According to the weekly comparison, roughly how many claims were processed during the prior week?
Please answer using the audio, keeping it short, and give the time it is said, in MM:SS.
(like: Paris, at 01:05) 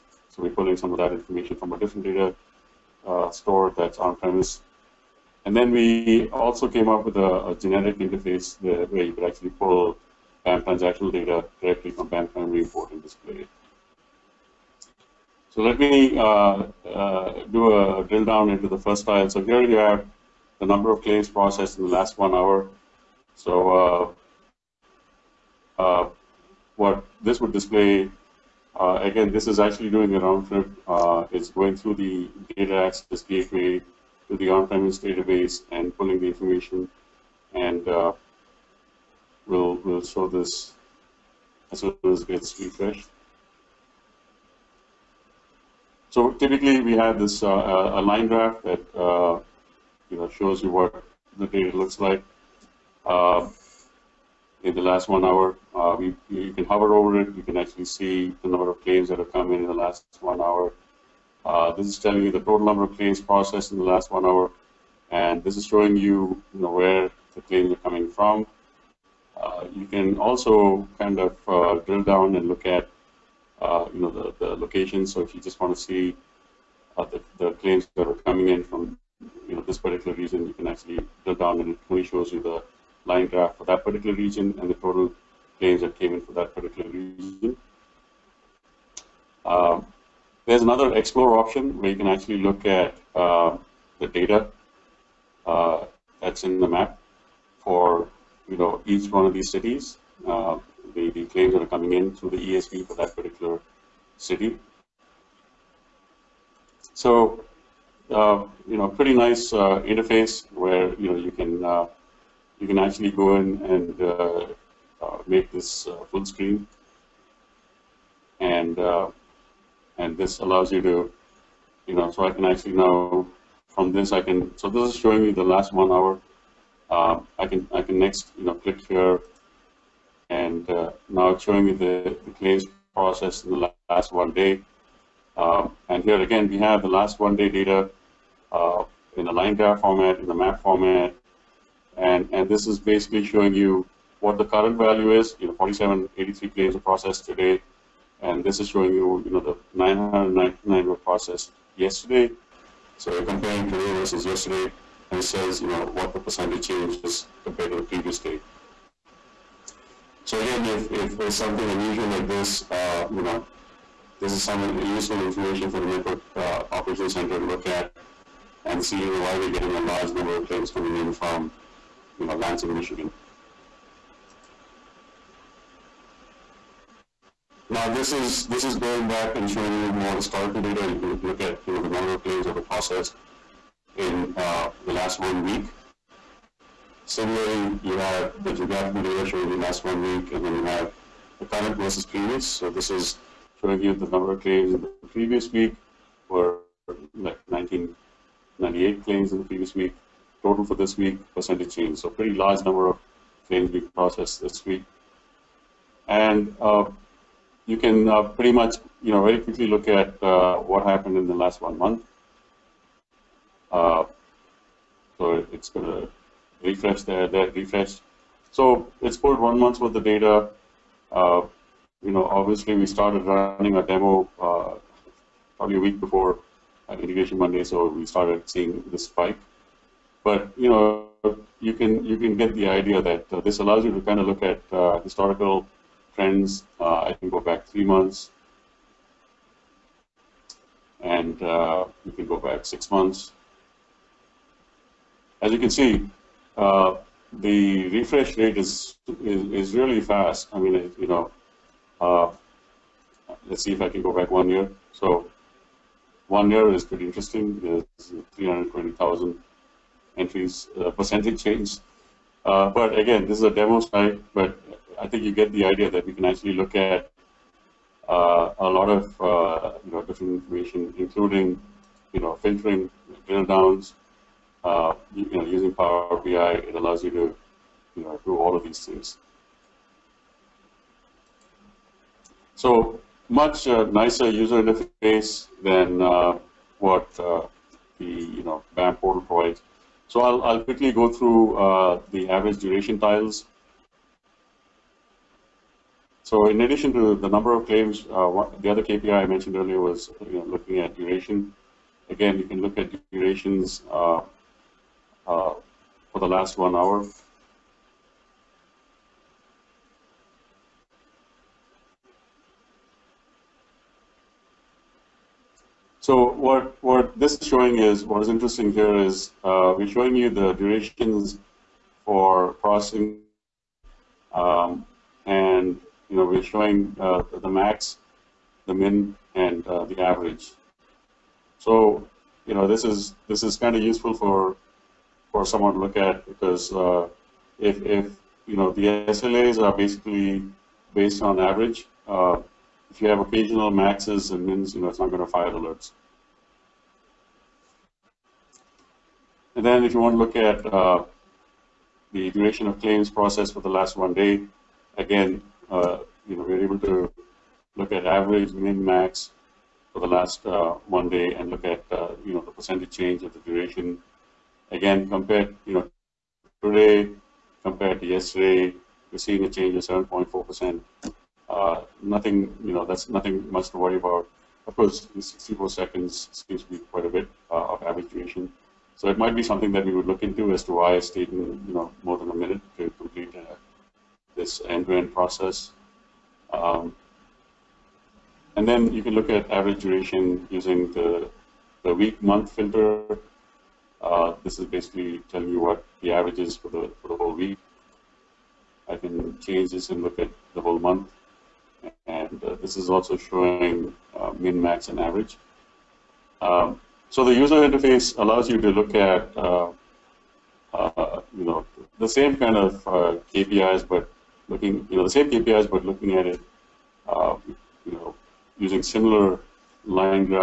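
1998, at 03:17.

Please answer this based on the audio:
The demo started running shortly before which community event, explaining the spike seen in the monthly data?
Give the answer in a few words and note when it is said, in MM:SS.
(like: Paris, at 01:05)
Integration Monday, at 03:46.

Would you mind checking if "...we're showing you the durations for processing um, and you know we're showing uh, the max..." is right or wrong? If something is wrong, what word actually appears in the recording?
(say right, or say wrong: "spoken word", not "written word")
right.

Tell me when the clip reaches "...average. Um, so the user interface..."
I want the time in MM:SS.
06:44.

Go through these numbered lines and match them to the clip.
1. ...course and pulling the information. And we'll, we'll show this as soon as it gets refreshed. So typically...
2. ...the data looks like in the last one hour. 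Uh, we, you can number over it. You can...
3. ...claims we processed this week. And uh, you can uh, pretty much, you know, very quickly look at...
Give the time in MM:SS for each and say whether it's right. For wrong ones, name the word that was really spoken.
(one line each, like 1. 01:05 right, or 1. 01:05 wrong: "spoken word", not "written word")
1. 00:35 wrong: "database", not "course"
2. 00:51 wrong: "hover", not "number"
3. 03:23 right.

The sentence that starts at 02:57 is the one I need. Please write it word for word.
Now this is this is going back and showing you more historical data.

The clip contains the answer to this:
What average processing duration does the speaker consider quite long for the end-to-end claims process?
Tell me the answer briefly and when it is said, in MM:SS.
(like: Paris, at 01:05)
64 seconds, at 06:15.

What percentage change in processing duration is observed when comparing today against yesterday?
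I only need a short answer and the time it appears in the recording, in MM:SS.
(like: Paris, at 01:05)
7.4%, at 06:10.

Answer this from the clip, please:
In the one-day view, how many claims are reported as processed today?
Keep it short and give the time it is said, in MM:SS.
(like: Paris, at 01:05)
4783, at 02:25.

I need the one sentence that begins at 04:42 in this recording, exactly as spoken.
So much uh, nicer user interface than uh, what uh, the you know BAM portal provides.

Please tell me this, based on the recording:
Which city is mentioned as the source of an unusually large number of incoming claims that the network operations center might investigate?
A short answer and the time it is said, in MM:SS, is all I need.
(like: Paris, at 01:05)
Lansing, Michigan, at 02:52.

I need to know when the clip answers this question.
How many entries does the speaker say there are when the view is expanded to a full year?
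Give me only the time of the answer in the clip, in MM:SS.
04:18.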